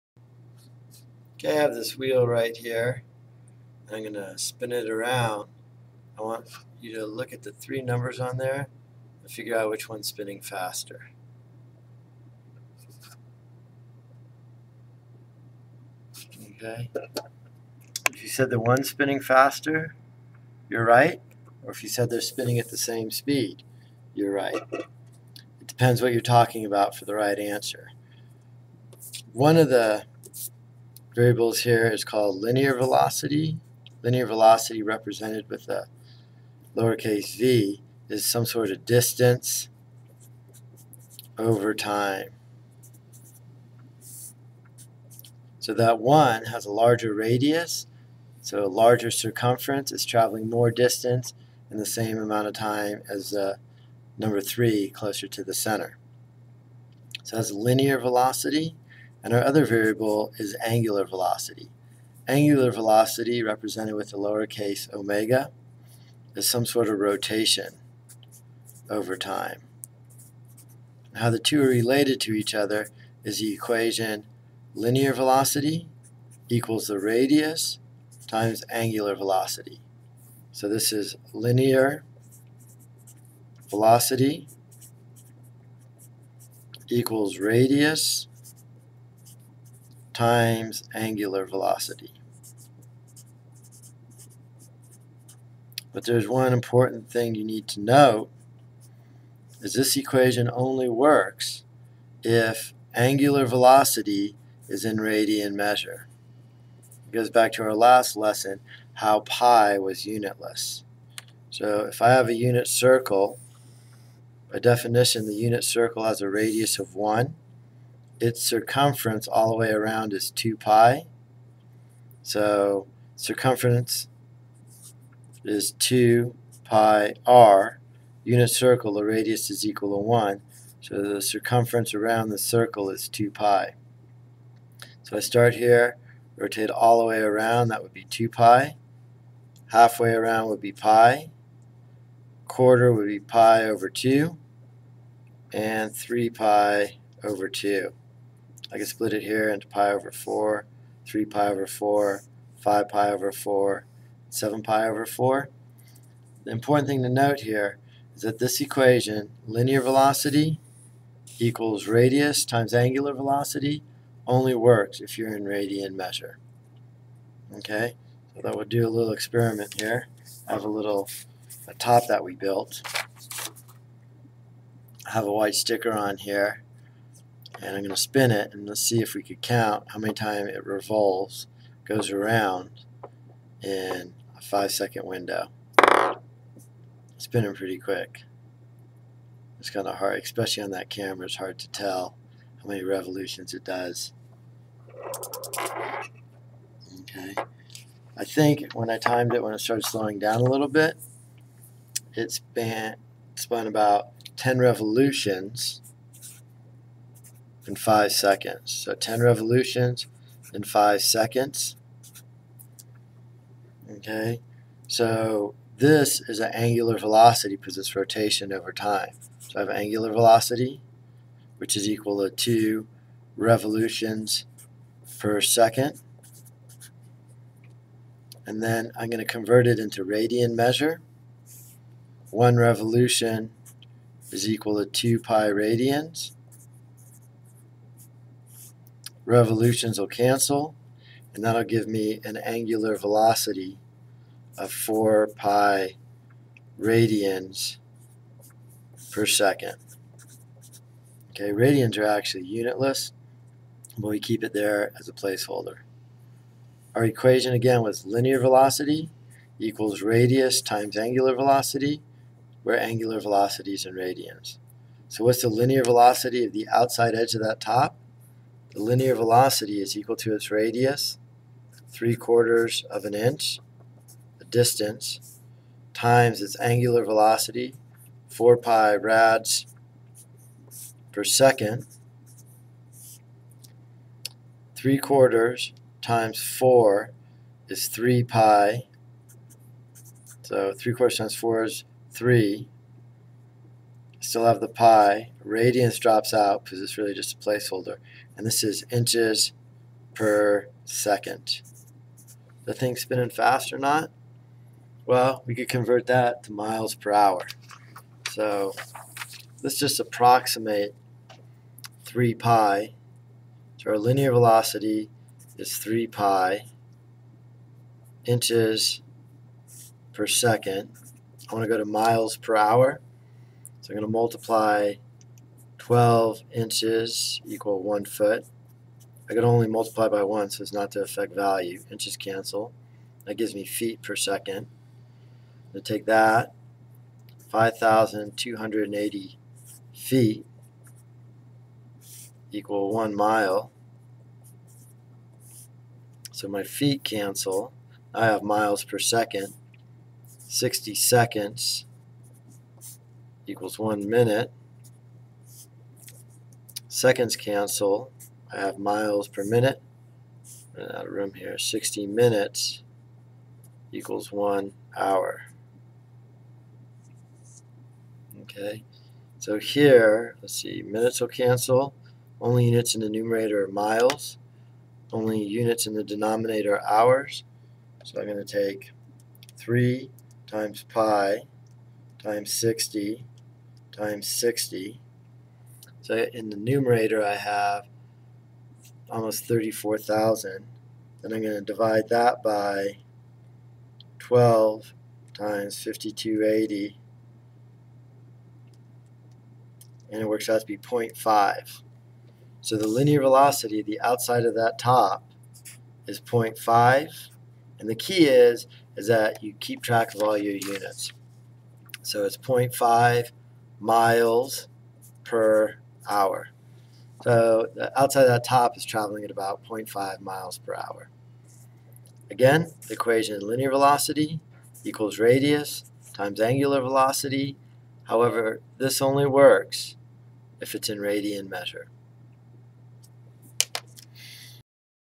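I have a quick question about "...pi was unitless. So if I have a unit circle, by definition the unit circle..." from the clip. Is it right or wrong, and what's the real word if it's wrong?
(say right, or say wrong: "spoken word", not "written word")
right.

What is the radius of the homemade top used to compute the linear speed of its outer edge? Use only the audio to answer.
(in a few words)
3/4 inch.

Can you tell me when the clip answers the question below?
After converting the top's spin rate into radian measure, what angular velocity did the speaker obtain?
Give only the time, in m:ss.
4:04.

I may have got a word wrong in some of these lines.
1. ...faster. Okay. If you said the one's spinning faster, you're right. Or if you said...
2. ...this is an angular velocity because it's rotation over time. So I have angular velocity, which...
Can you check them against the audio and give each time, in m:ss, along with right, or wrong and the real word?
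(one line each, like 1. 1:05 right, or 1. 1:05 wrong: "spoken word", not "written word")
1. 0:10 right
2. 3:35 right.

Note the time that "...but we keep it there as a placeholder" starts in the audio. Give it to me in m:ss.
4:13.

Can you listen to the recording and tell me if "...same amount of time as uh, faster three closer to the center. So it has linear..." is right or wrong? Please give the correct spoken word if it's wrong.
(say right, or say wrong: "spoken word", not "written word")
wrong: "number", not "faster".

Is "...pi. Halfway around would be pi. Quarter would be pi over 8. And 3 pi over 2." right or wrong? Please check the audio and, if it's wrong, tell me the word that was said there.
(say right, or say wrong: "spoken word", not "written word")
wrong: "2", not "8".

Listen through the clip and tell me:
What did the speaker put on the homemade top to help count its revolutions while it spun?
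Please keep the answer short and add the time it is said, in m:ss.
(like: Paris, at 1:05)
a white sticker, at 2:55.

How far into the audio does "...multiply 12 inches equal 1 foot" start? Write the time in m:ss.
5:24.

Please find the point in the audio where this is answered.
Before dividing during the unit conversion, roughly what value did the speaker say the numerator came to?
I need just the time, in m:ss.
6:29.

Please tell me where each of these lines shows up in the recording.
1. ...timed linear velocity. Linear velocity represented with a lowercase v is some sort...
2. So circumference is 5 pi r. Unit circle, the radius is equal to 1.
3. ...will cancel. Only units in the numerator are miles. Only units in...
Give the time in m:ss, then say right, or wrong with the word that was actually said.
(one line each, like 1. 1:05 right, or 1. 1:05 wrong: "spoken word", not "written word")
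1. 0:32 wrong: "called", not "timed"
2. 2:02 wrong: "2", not "5"
3. 6:11 right.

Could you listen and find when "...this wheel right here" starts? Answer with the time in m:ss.
0:01.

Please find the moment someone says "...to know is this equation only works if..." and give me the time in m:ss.
1:37.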